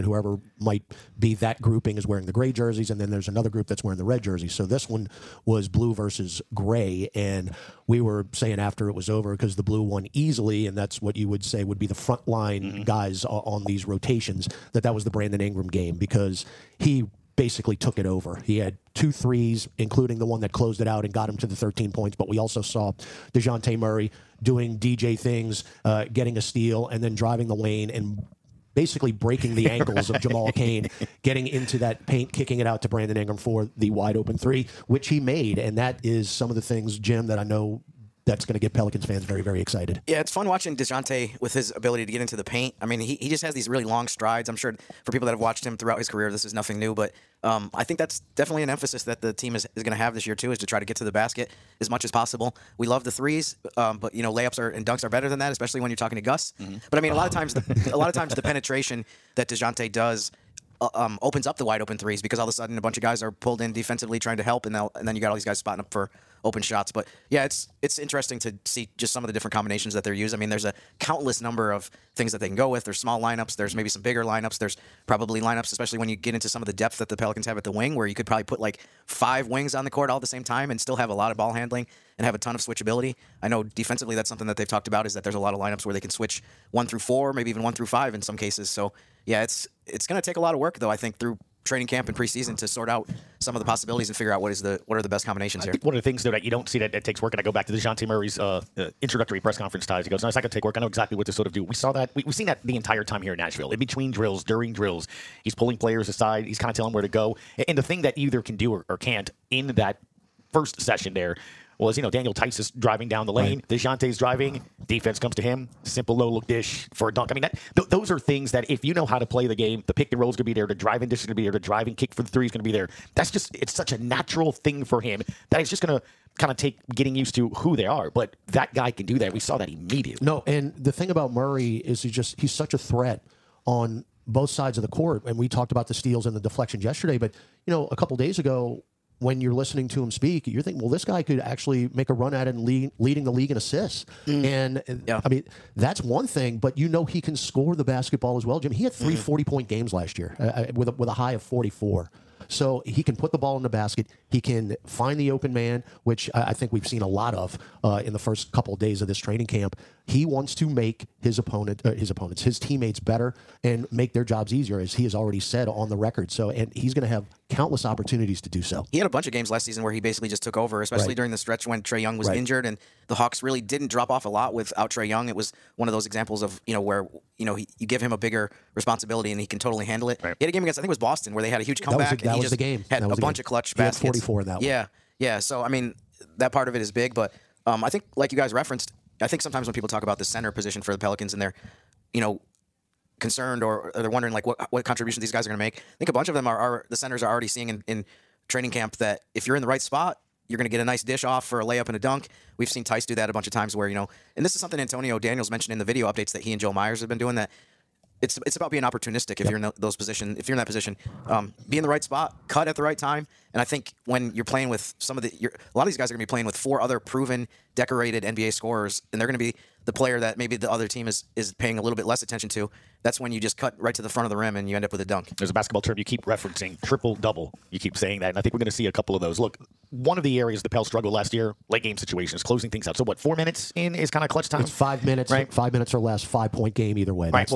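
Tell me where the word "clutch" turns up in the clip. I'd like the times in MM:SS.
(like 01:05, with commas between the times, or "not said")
03:03, 03:54.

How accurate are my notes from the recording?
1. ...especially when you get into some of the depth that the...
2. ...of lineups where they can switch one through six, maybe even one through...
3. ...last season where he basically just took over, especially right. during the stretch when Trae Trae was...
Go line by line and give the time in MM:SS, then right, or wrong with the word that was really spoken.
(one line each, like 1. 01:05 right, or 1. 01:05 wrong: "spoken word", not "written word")
1. 01:15 right
2. 01:25 wrong: "four", not "six"
3. 02:49 wrong: "Young", not "Trae".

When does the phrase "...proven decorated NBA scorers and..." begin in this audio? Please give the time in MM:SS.
03:36.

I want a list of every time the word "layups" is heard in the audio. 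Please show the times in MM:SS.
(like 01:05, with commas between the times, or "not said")
00:54, 03:21.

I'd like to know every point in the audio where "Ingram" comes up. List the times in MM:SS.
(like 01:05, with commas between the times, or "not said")
00:15, 00:33.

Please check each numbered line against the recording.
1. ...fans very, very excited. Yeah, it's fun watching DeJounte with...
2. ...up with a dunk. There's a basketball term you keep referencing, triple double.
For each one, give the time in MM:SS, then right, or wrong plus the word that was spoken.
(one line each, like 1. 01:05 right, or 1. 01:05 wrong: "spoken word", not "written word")
1. 00:39 right
2. 03:44 right.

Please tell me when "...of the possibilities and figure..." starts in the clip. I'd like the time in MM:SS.
01:33.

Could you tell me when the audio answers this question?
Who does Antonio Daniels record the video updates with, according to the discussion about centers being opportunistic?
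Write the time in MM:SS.
03:26.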